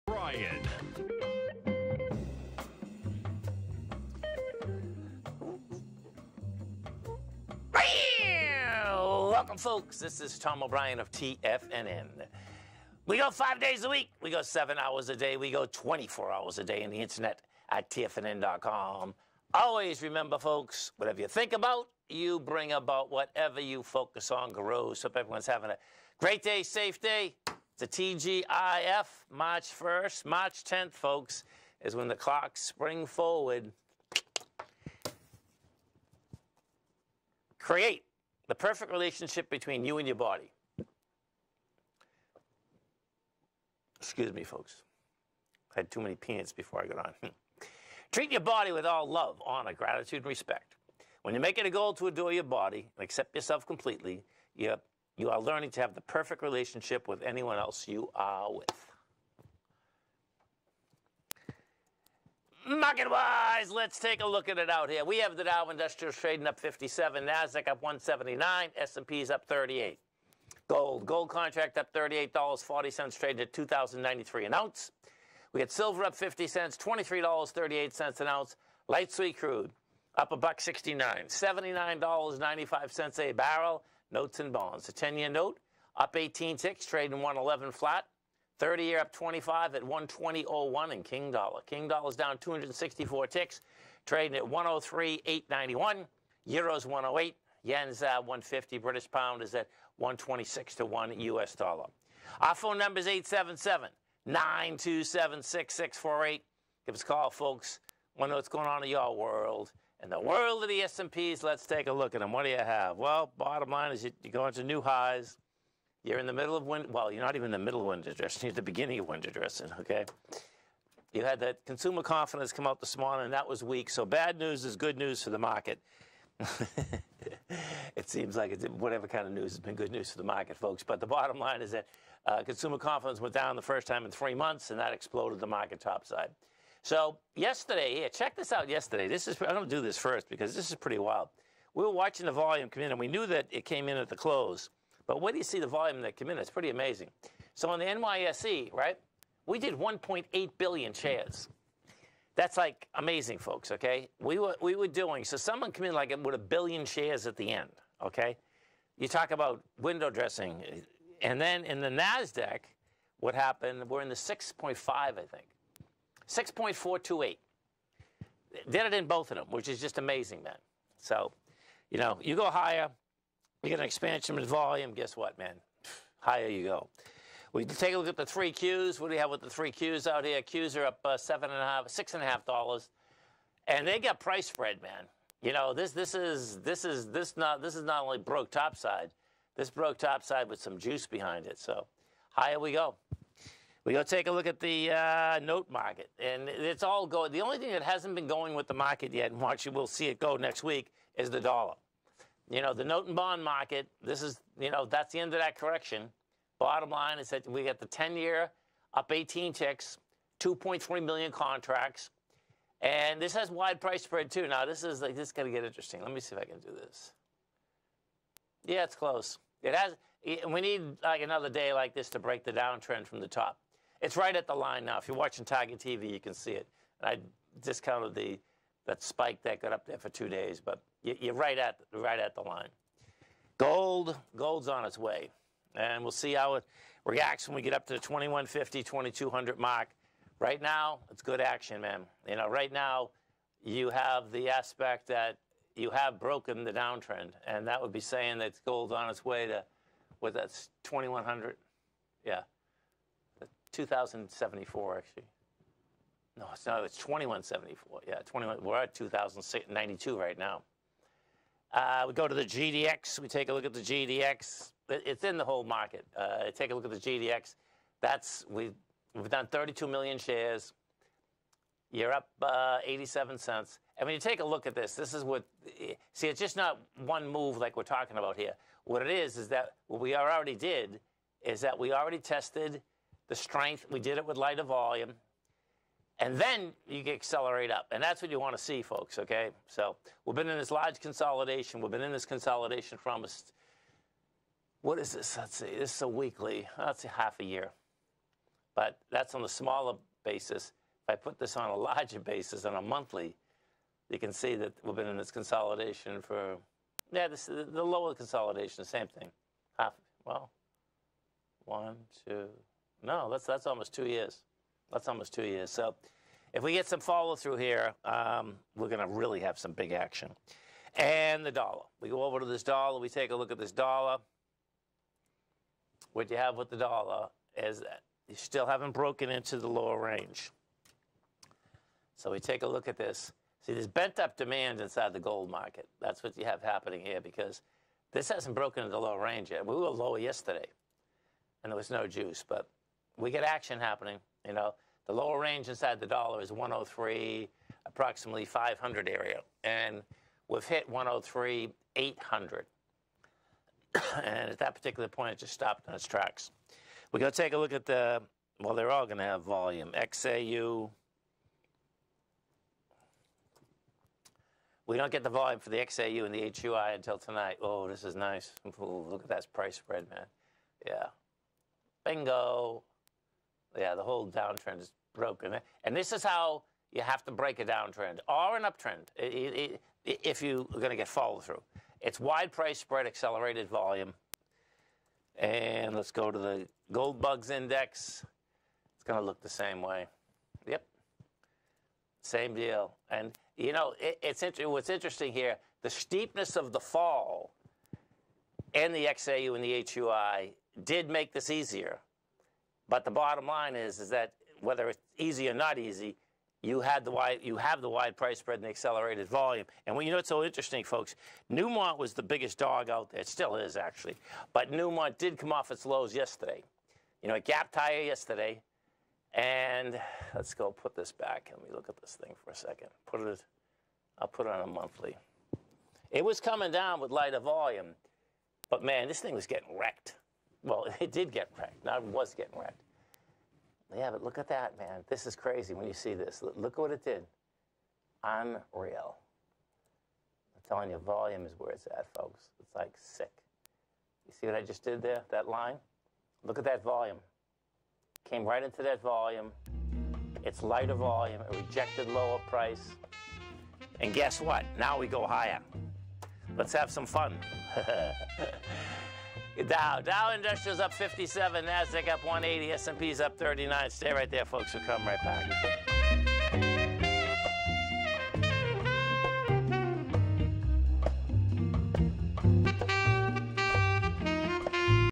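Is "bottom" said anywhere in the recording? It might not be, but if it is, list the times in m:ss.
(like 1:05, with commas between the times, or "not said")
1:53, 2:11, 3:26, 6:43.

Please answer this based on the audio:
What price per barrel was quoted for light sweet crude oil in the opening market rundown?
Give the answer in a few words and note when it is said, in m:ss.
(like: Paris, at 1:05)
$79.95, at 1:21.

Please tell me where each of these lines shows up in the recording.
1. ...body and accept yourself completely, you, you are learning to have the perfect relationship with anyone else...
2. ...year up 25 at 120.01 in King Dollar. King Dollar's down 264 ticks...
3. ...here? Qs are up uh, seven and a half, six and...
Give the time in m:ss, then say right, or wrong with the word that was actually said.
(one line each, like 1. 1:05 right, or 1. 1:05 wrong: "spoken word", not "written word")
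1. 0:52 right
2. 1:28 right
3. 3:00 right.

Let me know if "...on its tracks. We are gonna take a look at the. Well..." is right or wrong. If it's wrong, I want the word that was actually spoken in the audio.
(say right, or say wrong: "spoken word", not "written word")
right.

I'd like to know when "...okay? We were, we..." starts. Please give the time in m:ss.
2:33.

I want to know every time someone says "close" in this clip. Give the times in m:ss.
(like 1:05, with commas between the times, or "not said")
2:24, 3:38.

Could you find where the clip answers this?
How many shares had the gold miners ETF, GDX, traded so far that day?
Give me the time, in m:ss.
4:29.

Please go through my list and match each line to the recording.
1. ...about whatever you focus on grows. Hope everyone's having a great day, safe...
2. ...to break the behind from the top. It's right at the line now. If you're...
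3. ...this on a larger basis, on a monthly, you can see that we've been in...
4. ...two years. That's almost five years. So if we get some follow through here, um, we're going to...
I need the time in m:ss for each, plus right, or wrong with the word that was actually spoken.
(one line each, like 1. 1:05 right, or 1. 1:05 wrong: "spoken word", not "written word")
1. 0:22 right
2. 3:42 wrong: "downtrend", not "behind"
3. 5:01 right
4. 5:13 wrong: "two", not "five".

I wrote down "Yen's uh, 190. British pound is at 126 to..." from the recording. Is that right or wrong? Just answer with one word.
wrong.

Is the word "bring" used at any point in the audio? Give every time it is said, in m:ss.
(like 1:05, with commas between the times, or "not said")
0:22.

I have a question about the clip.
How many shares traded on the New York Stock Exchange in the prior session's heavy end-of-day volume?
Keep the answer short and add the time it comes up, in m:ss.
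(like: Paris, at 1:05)
1.8 billion, at 2:29.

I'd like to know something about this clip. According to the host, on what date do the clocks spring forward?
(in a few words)
March 10th.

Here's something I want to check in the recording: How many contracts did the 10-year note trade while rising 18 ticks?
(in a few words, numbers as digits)
2.3 million.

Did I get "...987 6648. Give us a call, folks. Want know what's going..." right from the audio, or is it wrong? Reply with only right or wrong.
wrong.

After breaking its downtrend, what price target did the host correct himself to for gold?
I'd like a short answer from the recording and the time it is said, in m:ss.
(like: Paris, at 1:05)
2174, at 4:16.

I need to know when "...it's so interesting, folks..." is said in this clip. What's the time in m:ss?
6:50.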